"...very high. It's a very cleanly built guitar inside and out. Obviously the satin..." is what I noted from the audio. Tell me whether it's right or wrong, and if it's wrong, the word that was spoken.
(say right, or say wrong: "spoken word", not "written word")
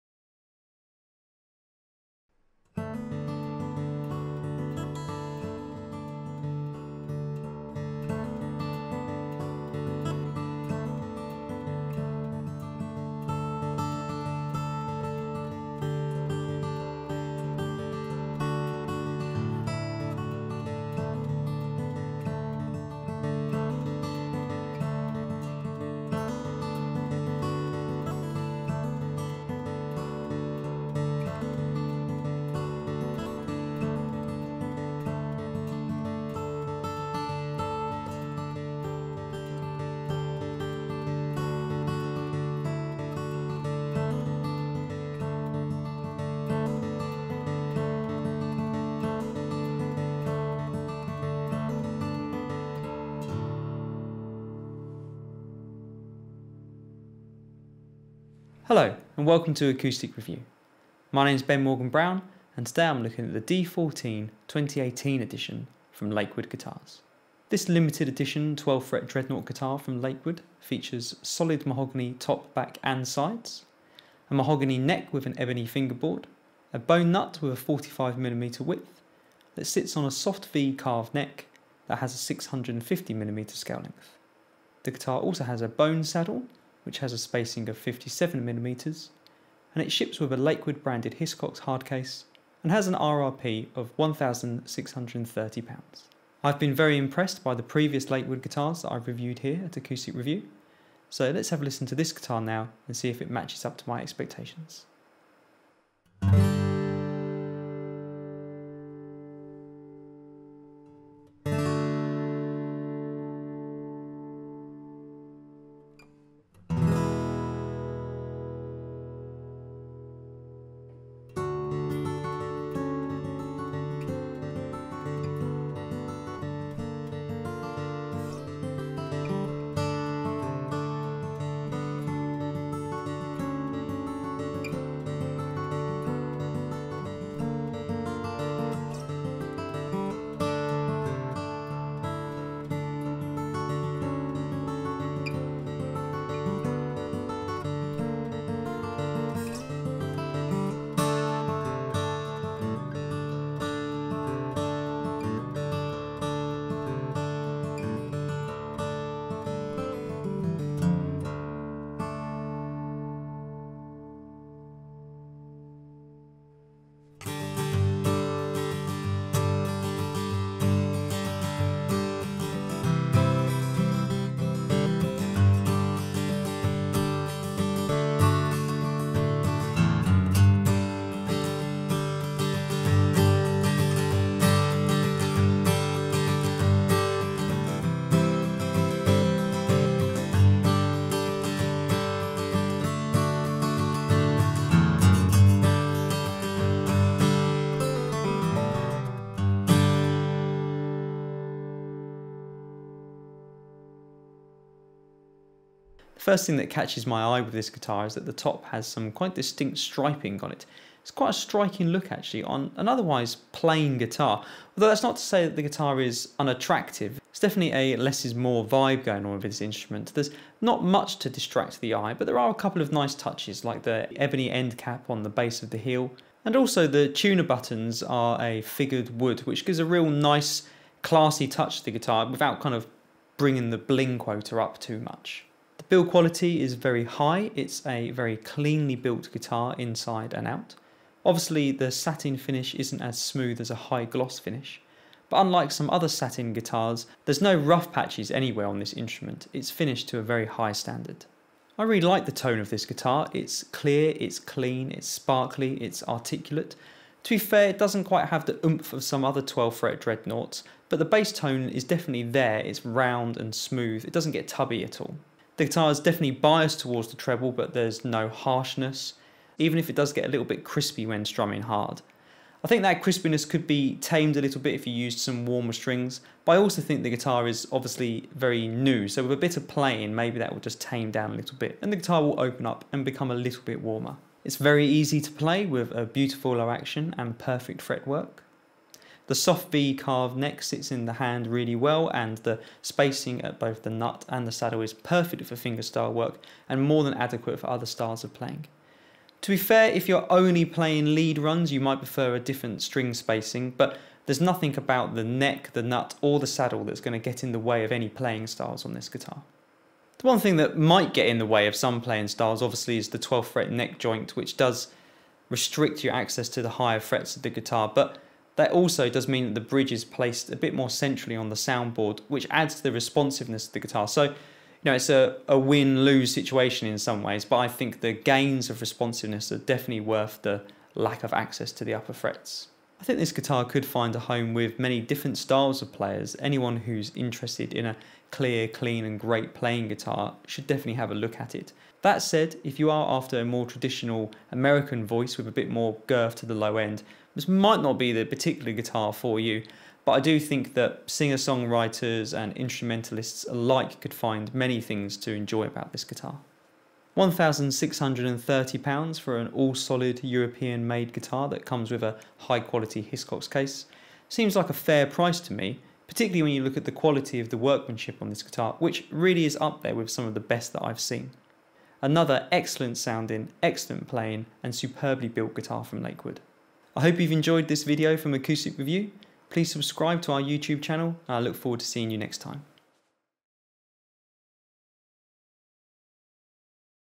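right.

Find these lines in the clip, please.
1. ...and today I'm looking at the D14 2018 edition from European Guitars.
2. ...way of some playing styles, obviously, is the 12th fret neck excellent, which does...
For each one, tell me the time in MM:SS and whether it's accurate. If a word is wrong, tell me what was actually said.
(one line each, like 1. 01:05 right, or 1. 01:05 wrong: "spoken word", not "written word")
1. 01:02 wrong: "Lakewood", not "European"
2. 05:11 wrong: "joint", not "excellent".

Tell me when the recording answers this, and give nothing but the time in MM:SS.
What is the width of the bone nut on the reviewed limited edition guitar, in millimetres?
01:17.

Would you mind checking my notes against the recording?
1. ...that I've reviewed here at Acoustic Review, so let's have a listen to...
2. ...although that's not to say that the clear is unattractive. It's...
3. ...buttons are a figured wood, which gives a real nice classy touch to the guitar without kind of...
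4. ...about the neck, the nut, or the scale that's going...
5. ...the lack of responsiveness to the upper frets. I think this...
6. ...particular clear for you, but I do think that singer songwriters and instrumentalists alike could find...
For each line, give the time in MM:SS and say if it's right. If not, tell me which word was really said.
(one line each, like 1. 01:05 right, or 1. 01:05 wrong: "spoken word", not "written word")
1. 01:38 right
2. 03:34 wrong: "guitar", not "clear"
3. 03:47 right
4. 05:04 wrong: "saddle", not "scale"
5. 05:30 wrong: "access", not "responsiveness"
6. 05:48 wrong: "guitar", not "clear".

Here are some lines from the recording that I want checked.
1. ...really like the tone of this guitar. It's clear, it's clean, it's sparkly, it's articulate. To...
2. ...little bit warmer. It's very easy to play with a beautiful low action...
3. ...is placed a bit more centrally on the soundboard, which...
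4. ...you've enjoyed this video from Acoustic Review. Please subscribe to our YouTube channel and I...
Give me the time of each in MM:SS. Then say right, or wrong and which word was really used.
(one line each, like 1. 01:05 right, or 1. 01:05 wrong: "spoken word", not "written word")
1. 04:11 right
2. 04:43 right
3. 05:19 right
4. 06:17 right.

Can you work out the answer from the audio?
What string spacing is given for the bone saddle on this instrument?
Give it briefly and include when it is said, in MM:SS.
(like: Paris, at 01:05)
57mm, at 01:27.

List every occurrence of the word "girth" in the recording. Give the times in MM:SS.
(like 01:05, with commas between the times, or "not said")
05:46.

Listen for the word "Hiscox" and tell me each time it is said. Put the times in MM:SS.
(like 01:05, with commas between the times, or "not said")
01:31, 06:03.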